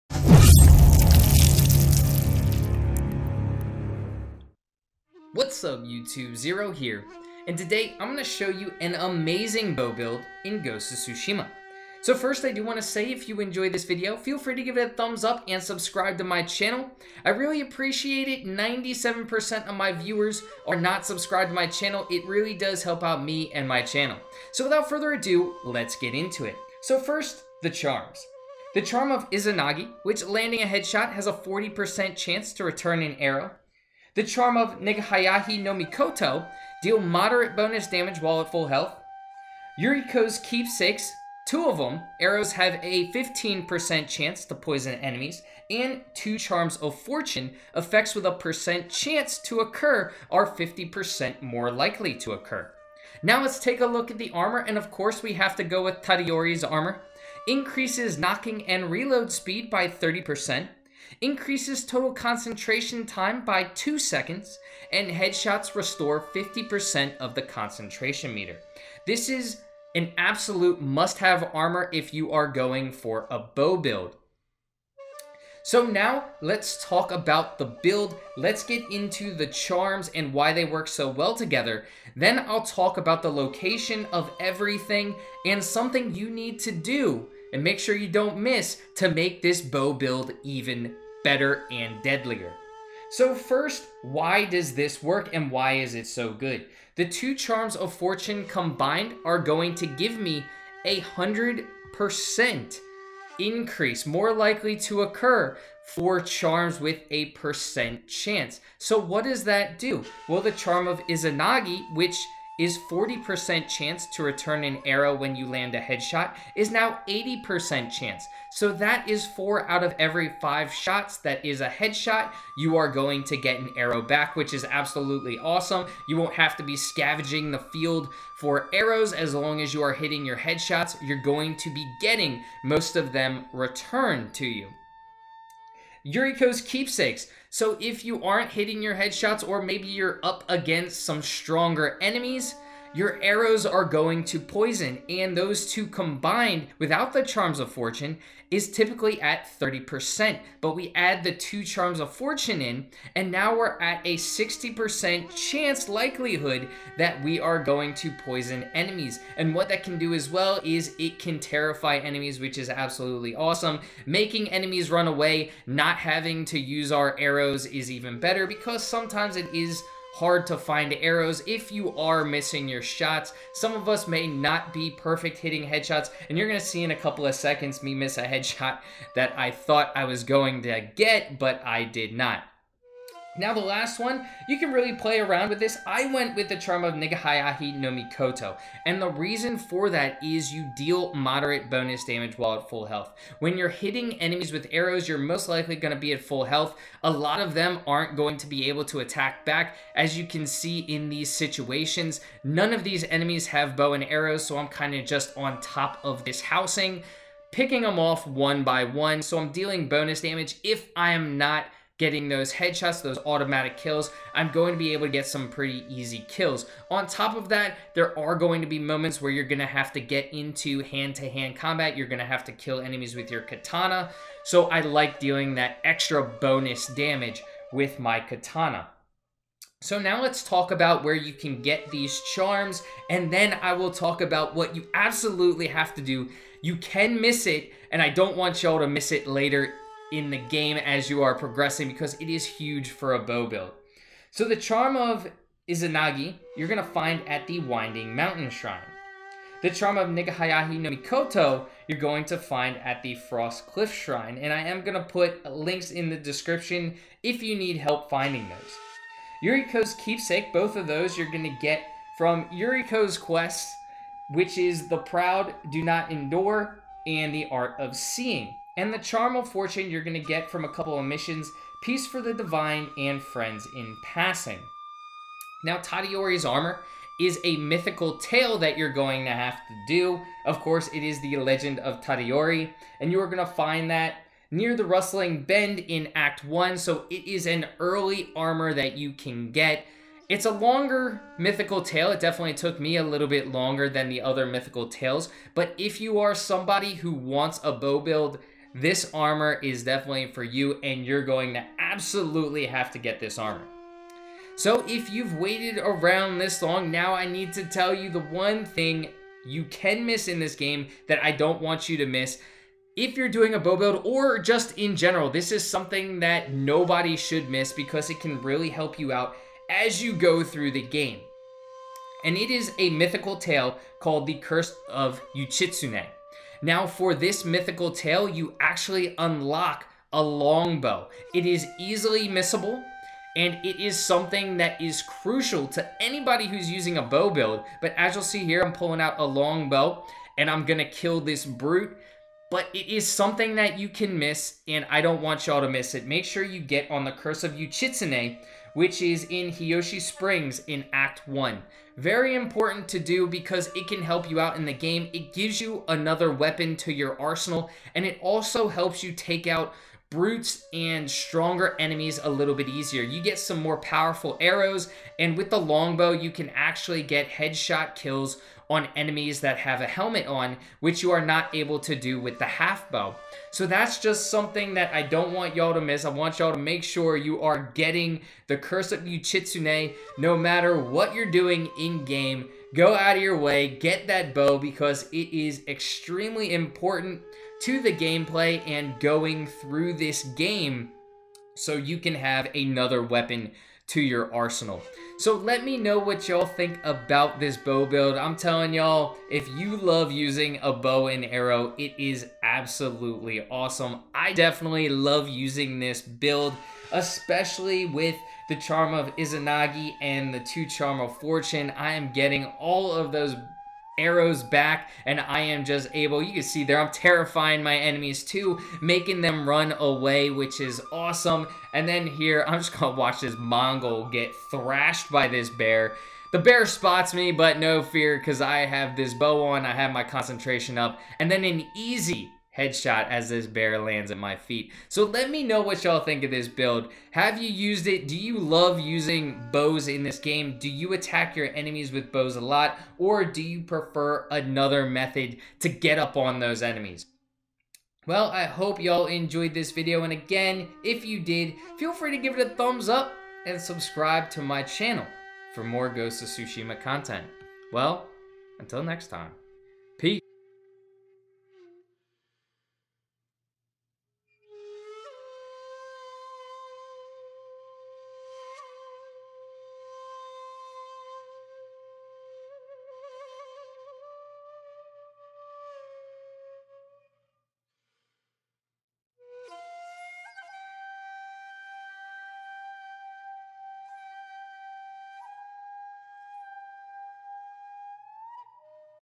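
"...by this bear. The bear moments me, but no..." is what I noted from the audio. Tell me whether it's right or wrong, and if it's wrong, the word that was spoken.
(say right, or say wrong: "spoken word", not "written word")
wrong: "spots", not "moments".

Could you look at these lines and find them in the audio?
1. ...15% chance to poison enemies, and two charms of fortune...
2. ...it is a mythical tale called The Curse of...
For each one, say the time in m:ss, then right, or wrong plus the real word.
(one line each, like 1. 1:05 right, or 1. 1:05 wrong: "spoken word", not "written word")
1. 0:43 right
2. 5:22 right.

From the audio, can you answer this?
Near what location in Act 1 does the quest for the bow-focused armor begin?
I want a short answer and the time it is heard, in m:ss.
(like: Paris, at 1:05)
Rustling Bend, at 4:44.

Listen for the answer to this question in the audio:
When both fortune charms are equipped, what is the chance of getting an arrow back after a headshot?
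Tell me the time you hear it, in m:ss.
1:57.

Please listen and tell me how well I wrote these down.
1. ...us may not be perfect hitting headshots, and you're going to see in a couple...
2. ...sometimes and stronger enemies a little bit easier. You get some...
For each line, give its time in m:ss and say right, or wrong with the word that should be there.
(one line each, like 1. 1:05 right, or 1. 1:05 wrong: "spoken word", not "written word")
1. 2:53 right
2. 6:00 wrong: "brutes", not "sometimes".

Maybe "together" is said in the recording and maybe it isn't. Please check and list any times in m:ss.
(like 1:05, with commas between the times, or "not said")
1:21.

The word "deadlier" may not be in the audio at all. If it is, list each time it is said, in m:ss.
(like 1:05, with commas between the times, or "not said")
1:32.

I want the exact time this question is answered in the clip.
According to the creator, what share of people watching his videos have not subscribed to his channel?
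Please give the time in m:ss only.
0:18.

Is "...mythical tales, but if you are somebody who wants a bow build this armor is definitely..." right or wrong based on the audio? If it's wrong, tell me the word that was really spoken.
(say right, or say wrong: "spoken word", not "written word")
right.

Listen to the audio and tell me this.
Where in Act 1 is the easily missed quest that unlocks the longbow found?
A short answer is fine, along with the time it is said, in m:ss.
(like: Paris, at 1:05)
Hiyoshi Springs, at 5:49.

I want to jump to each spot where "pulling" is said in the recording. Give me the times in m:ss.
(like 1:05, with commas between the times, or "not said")
5:38.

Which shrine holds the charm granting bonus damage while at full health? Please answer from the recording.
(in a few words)
Frost Cliff Shrine.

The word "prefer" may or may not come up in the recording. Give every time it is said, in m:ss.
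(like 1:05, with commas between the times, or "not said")
7:23.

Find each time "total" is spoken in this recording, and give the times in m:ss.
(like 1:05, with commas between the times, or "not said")
1:01.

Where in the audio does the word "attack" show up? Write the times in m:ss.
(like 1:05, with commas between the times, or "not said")
3:18, 7:20.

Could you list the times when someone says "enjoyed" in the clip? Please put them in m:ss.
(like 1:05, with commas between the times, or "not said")
0:13, 7:29.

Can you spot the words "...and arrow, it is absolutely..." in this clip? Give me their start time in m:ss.
6:41.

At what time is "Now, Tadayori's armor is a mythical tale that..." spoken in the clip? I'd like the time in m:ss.
4:35.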